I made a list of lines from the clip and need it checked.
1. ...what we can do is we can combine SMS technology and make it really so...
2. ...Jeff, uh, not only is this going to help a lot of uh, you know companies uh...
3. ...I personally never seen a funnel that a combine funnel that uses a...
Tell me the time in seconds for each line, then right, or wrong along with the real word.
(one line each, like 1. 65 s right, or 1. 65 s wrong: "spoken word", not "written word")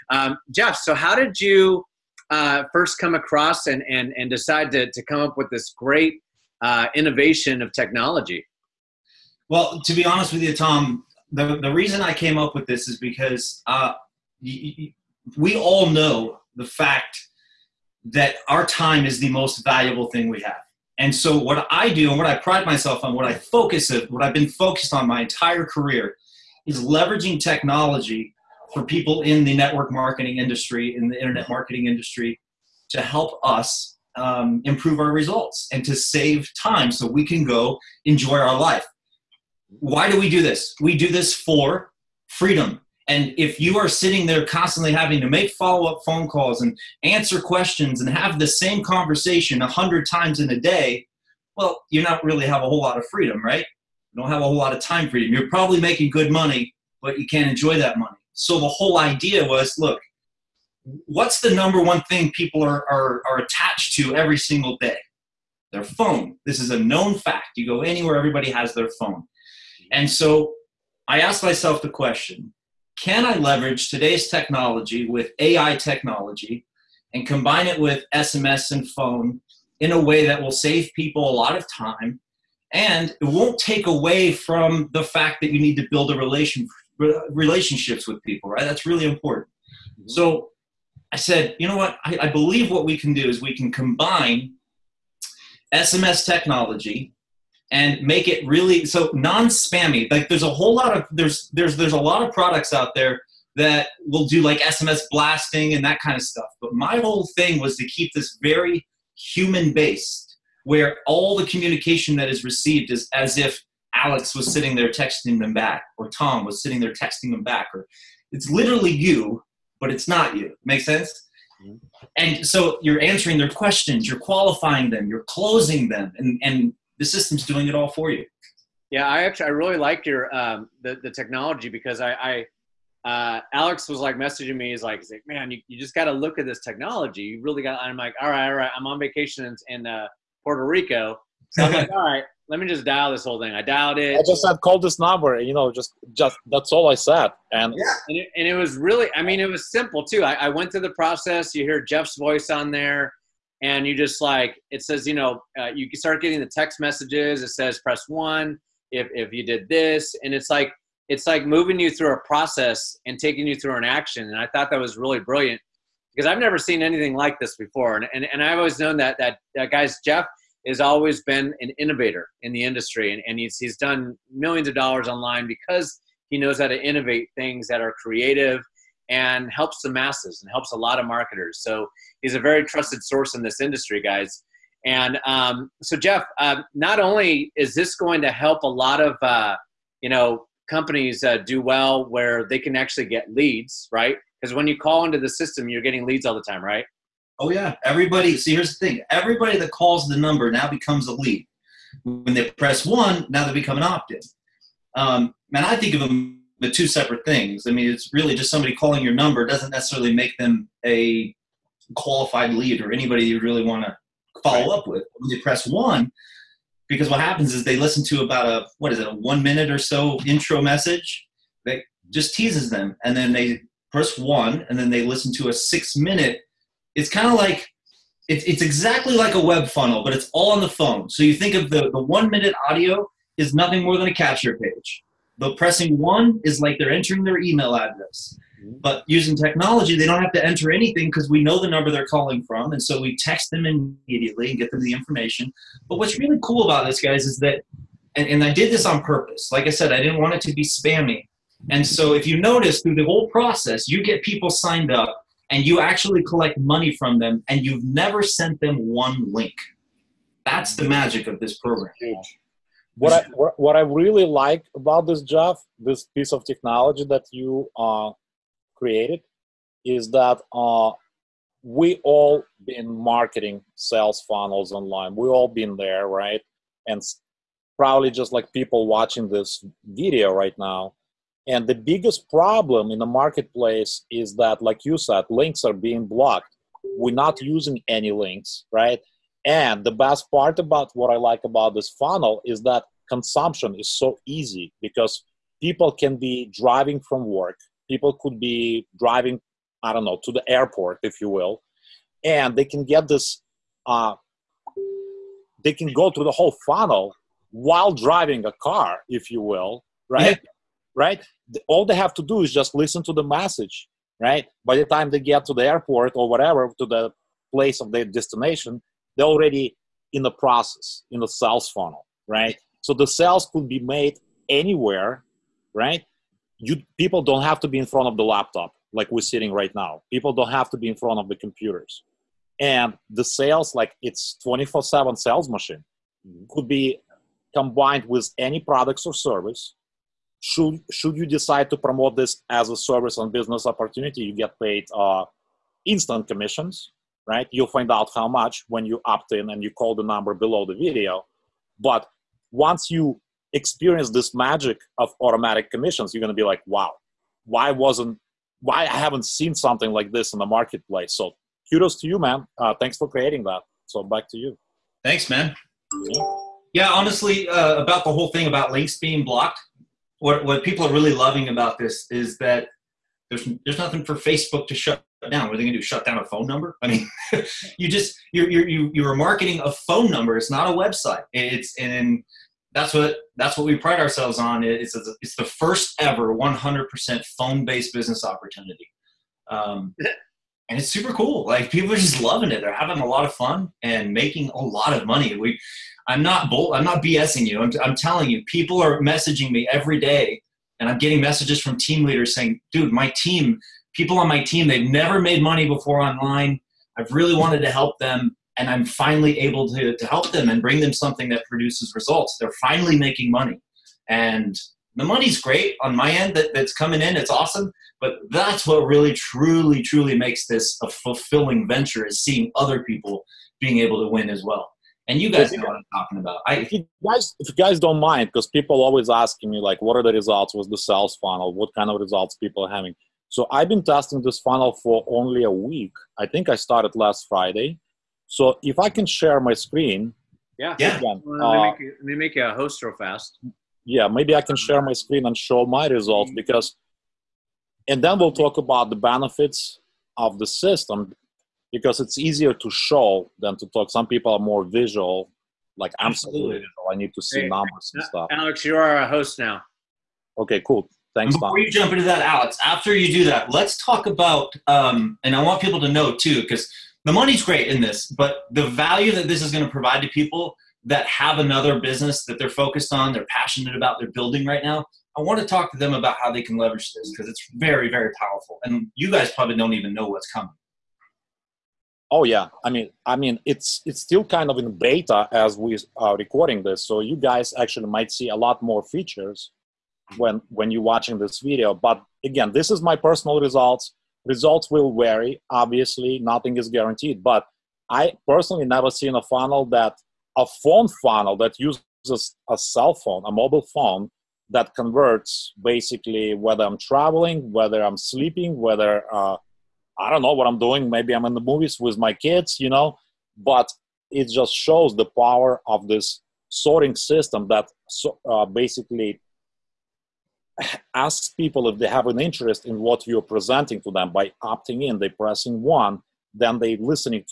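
1. 92 s right
2. 185 s right
3. 497 s wrong: "phone", not "combine".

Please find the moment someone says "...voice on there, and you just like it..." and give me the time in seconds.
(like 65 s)
152 s.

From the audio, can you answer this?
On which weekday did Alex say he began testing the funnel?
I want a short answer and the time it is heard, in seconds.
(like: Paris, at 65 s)
Friday, at 437 s.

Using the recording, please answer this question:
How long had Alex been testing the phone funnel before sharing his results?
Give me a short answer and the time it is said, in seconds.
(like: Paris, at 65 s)
A week, at 435 s.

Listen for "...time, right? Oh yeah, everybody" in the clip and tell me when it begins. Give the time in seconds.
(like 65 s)
196 s.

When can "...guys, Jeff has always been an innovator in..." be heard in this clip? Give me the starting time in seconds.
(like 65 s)
169 s.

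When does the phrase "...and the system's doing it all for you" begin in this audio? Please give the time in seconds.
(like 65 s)
126 s.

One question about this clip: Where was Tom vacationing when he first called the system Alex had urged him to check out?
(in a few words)
Puerto Rico.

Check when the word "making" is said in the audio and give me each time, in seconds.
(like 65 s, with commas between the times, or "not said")
55 s, 394 s, 412 s.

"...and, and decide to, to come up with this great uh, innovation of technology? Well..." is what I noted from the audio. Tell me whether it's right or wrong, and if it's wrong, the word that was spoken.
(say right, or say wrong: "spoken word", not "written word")
right.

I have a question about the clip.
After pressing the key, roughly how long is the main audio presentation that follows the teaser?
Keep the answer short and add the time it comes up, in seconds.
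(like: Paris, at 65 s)
6 minutes, at 225 s.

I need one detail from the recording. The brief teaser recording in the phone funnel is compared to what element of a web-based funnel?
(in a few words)
A capture page.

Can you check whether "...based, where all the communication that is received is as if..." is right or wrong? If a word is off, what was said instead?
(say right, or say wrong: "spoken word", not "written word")
right.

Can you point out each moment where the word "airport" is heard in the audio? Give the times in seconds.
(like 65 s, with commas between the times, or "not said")
300 s, 315 s.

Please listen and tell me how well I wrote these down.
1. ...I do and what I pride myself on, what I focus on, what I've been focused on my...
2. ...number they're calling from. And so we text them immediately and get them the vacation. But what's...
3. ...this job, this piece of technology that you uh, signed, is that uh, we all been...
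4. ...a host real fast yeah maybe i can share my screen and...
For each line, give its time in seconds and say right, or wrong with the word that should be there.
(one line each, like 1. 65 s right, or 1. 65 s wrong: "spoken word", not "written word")
1. 21 s right
2. 241 s wrong: "information", not "vacation"
3. 265 s wrong: "created", not "signed"
4. 442 s right.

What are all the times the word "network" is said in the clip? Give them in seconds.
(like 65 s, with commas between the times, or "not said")
29 s.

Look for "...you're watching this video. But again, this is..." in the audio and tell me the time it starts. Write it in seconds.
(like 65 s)
490 s.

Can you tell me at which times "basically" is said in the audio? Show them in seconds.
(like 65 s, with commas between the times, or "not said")
505 s, 518 s.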